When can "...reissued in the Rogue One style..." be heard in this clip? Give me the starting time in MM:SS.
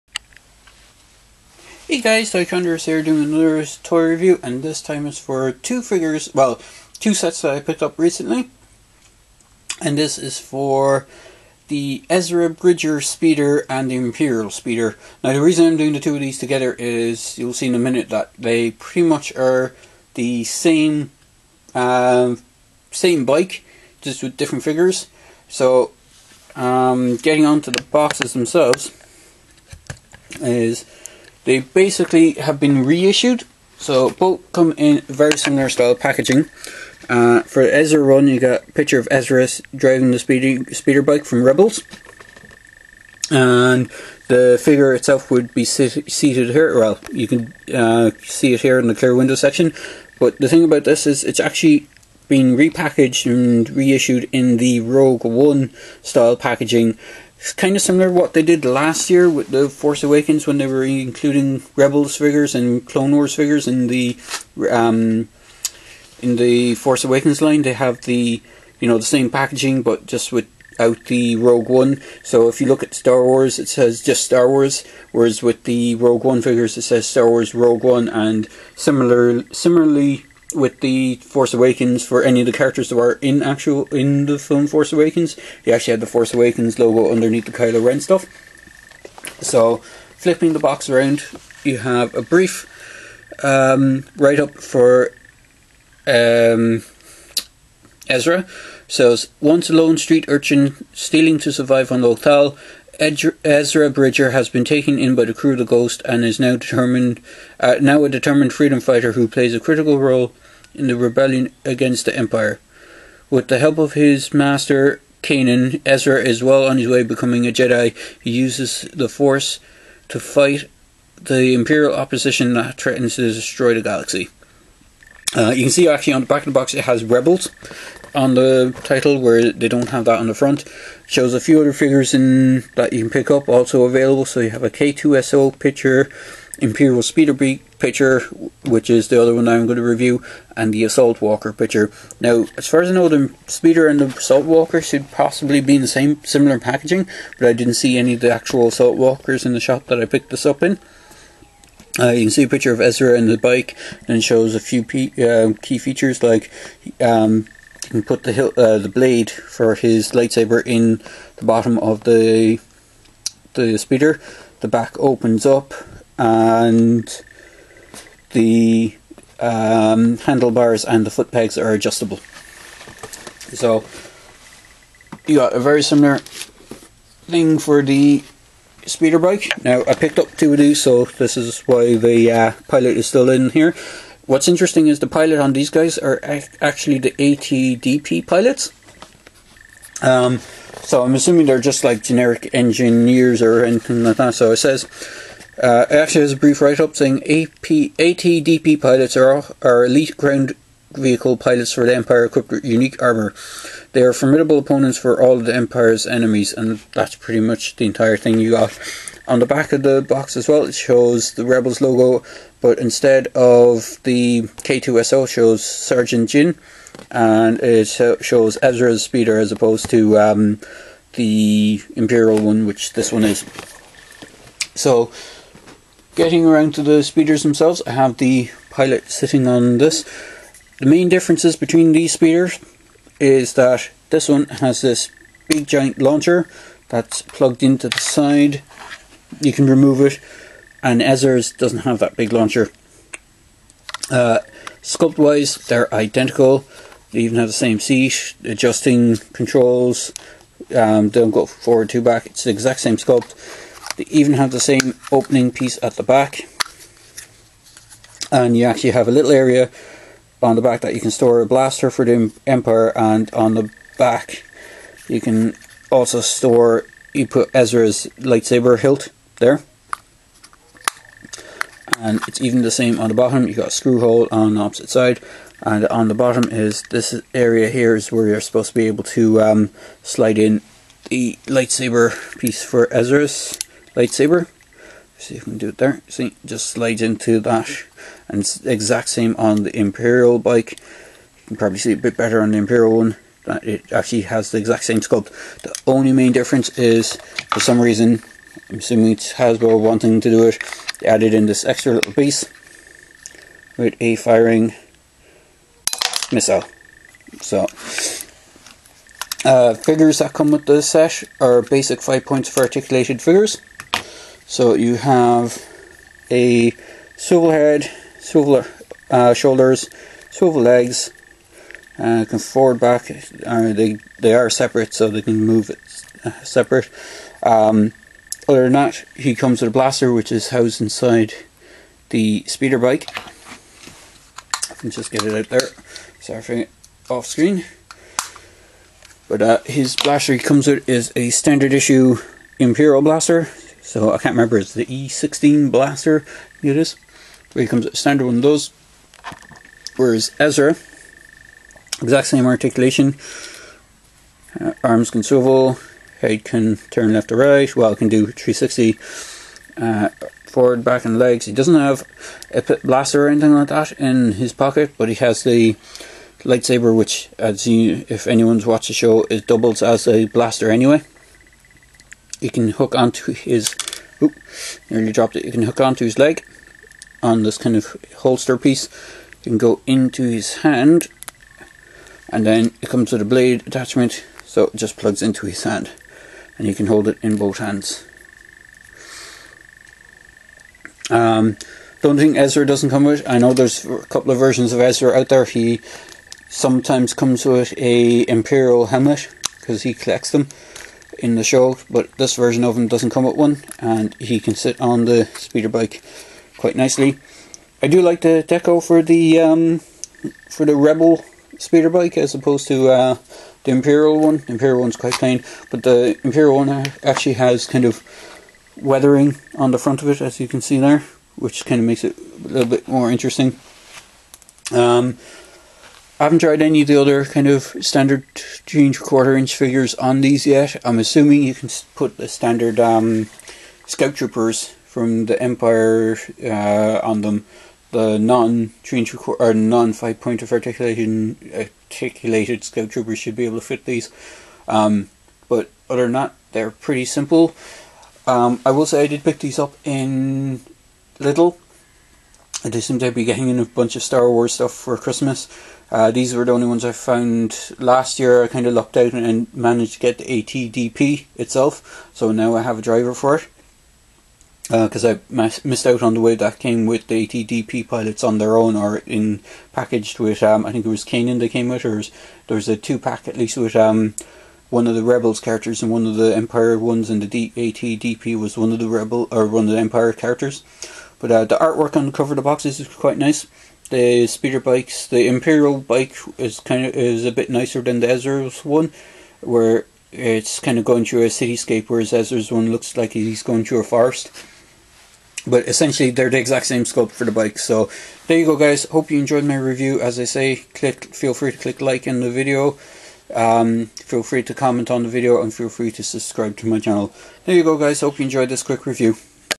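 00:53.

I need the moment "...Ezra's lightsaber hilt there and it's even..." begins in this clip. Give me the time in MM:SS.
04:27.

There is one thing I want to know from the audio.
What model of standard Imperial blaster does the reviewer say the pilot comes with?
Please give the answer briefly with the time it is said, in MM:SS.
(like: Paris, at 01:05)
E16 Blaster, at 05:44.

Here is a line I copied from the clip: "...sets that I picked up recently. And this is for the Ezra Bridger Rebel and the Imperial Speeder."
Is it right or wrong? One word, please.
wrong.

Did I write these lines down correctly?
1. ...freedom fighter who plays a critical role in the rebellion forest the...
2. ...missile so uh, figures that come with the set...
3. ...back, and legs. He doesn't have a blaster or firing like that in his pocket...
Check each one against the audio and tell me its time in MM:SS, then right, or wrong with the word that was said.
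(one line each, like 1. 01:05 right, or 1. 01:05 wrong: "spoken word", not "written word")
1. 01:48 wrong: "against", not "forest"
2. 05:06 right
3. 06:00 wrong: "anything", not "firing".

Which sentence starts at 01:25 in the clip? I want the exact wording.
you actually had the Force Awakens logo underneath the Kylo Ren stuff.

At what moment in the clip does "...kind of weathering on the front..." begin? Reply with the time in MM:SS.
06:57.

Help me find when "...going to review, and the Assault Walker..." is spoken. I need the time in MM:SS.
02:19.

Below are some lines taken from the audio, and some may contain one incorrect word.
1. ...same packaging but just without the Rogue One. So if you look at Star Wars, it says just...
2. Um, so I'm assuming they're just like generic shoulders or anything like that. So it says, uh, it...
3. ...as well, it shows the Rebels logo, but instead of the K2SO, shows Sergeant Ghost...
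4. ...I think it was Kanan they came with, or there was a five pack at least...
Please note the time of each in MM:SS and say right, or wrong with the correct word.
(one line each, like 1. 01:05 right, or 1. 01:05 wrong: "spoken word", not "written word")
1. 01:09 right
2. 03:10 wrong: "engineers", not "shoulders"
3. 03:30 wrong: "Jyn", not "Ghost"
4. 07:50 wrong: "two", not "five".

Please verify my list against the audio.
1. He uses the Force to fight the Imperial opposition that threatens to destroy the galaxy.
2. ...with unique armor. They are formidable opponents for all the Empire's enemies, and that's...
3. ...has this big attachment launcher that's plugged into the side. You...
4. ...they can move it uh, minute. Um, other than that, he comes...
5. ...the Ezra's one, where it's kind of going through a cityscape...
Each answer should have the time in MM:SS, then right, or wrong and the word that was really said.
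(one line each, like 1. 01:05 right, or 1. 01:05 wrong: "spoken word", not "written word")
1. 01:58 right
2. 03:22 right
3. 03:54 wrong: "giant", not "attachment"
4. 05:25 wrong: "separate", not "minute"
5. 08:07 right.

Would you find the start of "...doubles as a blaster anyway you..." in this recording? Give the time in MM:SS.
06:09.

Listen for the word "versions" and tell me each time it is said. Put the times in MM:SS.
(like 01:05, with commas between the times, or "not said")
06:34, 06:42.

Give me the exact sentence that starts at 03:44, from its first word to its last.
So, getting around to the speeders themselves, I have the pilot sitting on this.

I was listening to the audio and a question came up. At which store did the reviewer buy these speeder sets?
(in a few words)
Lidl.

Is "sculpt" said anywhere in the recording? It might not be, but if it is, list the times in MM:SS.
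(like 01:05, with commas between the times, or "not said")
04:04, 04:12, 04:54, 08:16.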